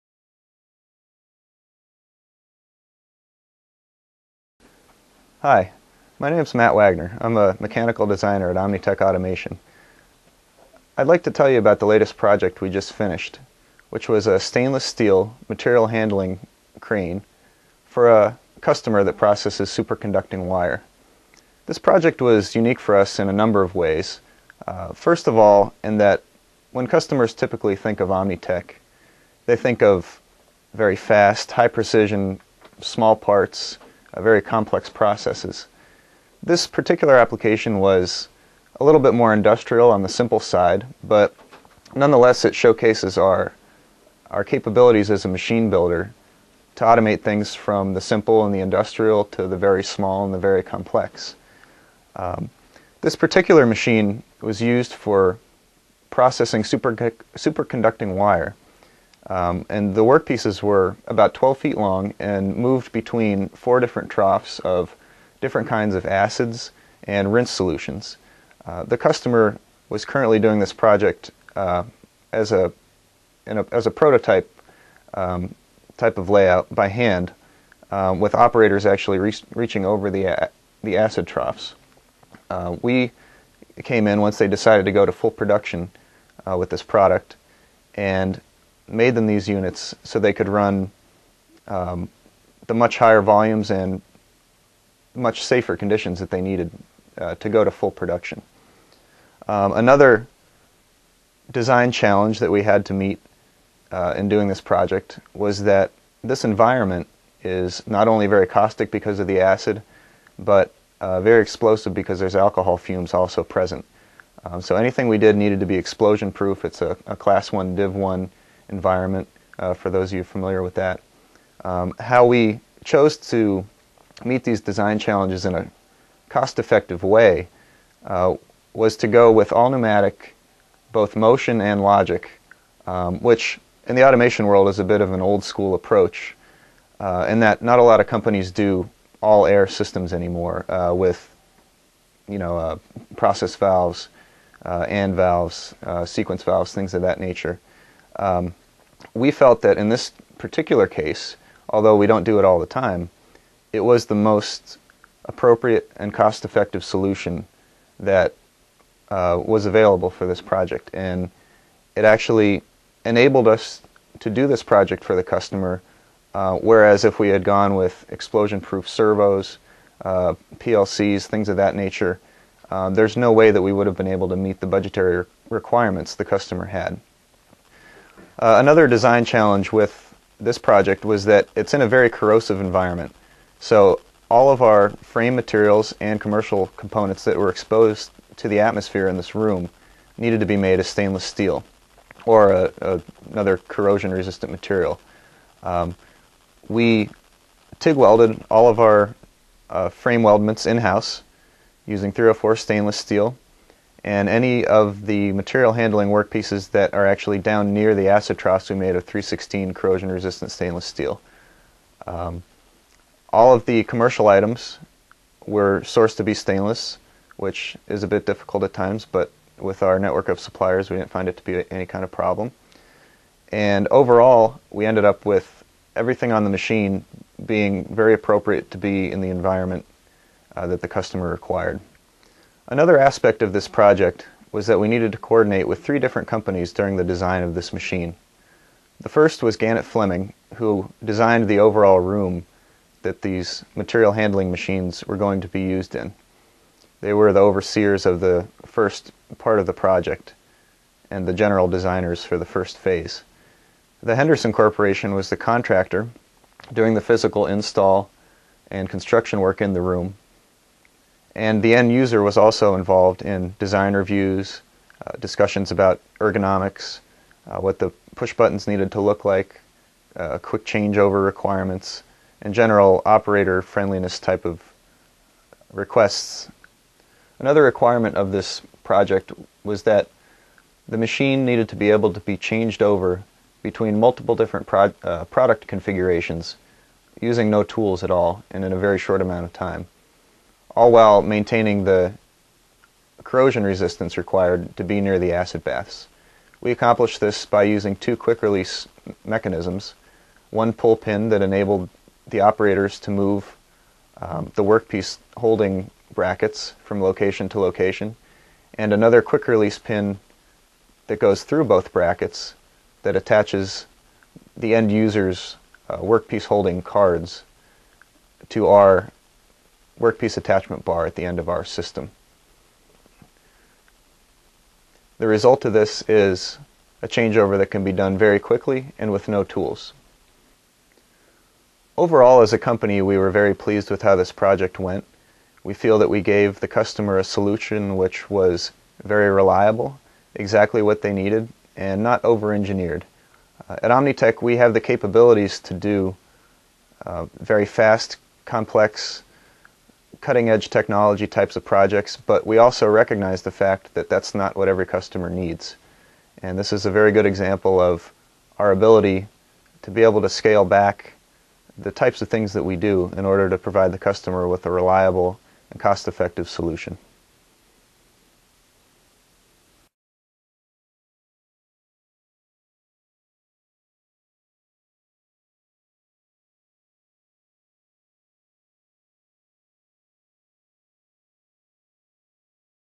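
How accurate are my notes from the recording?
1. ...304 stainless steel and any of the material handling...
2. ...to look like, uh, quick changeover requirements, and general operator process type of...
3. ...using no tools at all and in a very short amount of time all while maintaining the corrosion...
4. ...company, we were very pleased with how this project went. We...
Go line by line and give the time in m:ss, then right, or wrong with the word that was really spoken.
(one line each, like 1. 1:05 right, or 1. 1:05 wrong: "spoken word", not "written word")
1. 3:22 right
2. 4:28 wrong: "friendliness", not "process"
3. 4:47 right
4. 5:32 right.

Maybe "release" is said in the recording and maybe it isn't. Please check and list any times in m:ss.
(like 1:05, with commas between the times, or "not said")
4:58, 5:09.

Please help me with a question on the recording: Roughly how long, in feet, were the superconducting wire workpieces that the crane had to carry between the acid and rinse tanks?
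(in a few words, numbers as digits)
12 feet.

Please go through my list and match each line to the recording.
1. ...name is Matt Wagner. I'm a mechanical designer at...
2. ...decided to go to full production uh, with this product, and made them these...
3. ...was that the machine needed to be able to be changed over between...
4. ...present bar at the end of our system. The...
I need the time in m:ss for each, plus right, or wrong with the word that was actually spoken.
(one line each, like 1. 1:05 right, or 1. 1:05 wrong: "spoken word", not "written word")
1. 0:06 right
2. 1:24 right
3. 4:39 right
4. 5:20 wrong: "attachment", not "present".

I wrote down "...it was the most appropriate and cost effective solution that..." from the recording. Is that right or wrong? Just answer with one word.
right.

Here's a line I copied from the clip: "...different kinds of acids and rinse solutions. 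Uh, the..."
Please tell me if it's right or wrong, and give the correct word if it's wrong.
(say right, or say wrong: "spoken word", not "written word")
right.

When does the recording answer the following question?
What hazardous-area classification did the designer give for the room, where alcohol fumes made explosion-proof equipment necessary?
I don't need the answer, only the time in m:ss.
1:57.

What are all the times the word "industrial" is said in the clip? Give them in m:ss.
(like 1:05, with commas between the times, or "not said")
0:39, 0:48.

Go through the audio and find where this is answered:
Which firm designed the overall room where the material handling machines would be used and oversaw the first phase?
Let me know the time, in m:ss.
3:59.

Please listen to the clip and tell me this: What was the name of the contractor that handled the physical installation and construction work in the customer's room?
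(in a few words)
Henderson Corporation.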